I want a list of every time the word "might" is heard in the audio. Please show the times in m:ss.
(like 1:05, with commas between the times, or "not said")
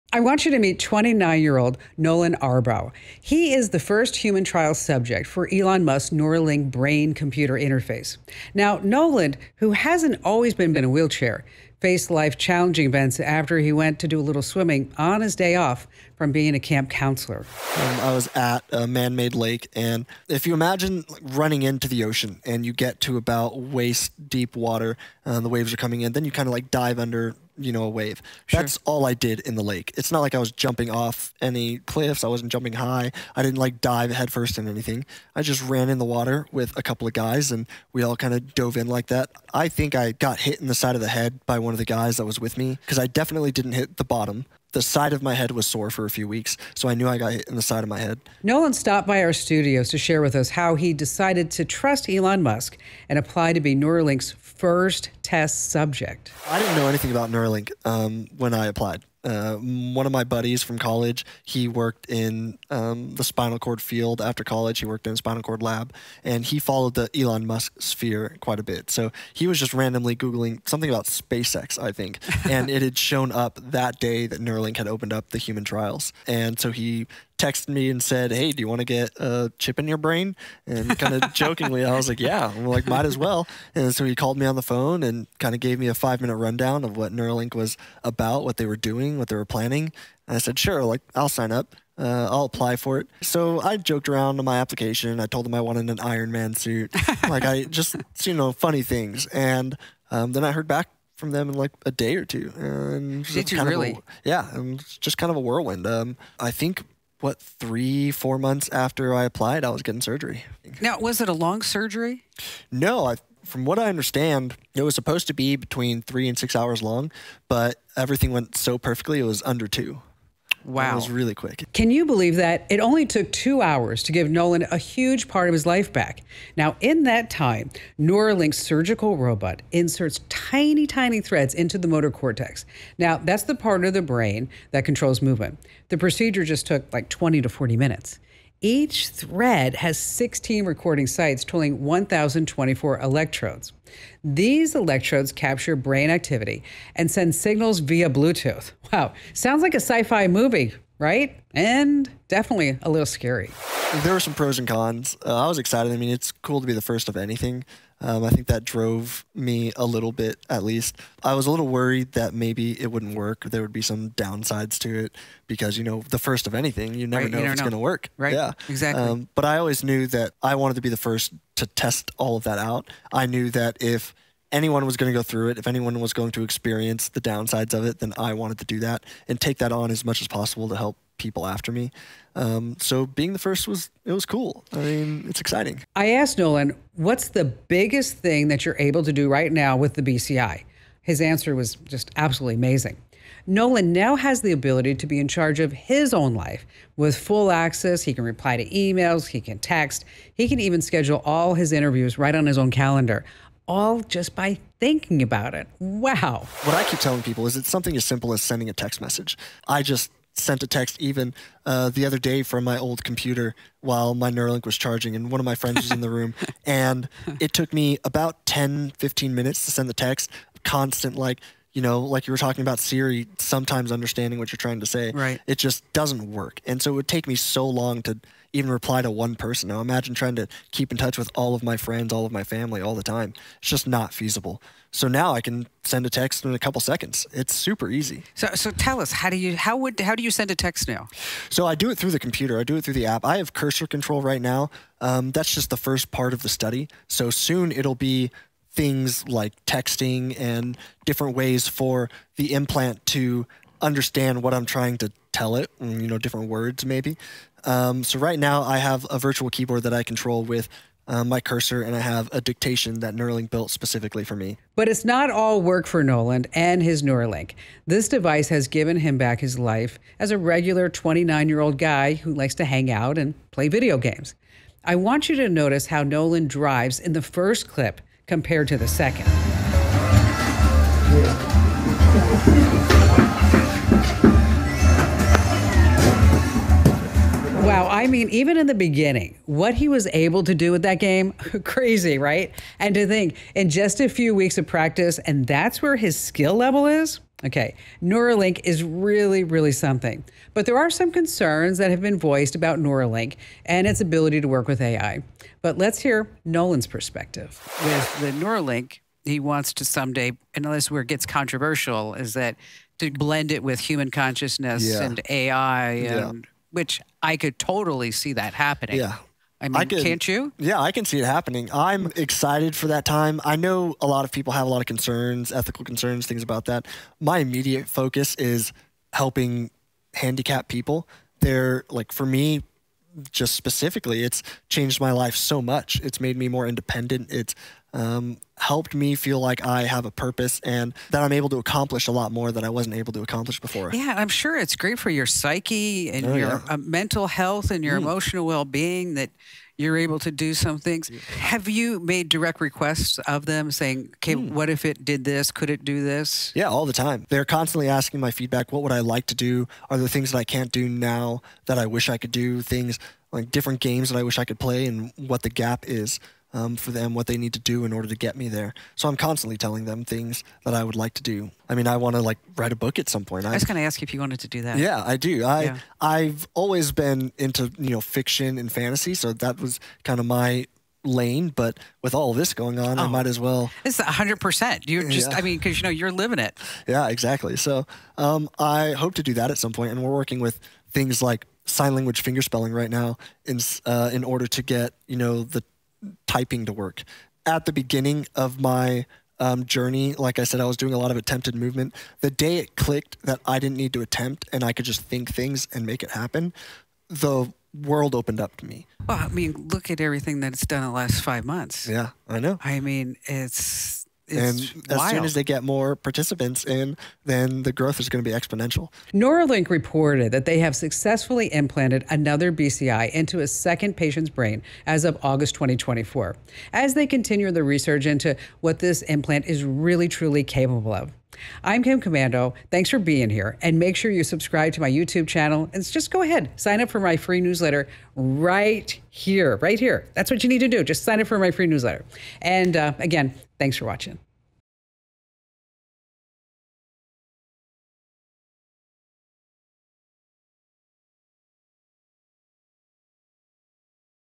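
1:22, 6:23.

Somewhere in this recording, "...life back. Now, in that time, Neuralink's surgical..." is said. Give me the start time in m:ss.
2:05.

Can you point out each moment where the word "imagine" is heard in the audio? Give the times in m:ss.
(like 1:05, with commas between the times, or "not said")
0:20, 3:49.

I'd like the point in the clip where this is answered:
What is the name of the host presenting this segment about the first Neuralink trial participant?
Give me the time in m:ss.
7:11.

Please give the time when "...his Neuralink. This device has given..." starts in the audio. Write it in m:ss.
4:26.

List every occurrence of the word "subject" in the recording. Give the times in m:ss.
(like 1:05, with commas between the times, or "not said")
0:04, 0:55.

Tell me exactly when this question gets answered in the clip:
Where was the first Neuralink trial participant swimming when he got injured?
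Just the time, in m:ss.
0:18.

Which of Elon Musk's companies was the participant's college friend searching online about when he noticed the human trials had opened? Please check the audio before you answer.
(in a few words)
SpaceX.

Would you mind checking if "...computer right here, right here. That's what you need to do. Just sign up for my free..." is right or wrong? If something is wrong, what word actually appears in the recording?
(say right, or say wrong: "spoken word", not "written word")
wrong: "newsletter", not "computer".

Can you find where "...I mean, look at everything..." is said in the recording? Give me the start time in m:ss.
6:49.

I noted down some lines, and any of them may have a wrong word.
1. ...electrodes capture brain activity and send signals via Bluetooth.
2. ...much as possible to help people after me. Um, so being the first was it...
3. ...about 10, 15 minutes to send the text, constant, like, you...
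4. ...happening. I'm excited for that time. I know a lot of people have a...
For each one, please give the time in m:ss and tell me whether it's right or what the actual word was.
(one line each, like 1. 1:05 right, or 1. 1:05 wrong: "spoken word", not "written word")
1. 2:24 right
2. 3:00 right
3. 3:38 right
4. 5:21 right.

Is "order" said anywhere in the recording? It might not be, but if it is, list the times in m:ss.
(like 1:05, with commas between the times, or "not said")
6:07, 6:34.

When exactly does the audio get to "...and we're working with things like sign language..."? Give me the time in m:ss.
6:29.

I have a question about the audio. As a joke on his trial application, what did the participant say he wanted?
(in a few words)
Iron Man suit.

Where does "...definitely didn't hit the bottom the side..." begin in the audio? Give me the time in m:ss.
0:43.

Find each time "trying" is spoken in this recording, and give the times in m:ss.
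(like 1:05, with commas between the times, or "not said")
3:44, 3:50, 4:14.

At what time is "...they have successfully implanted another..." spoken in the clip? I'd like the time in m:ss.
7:00.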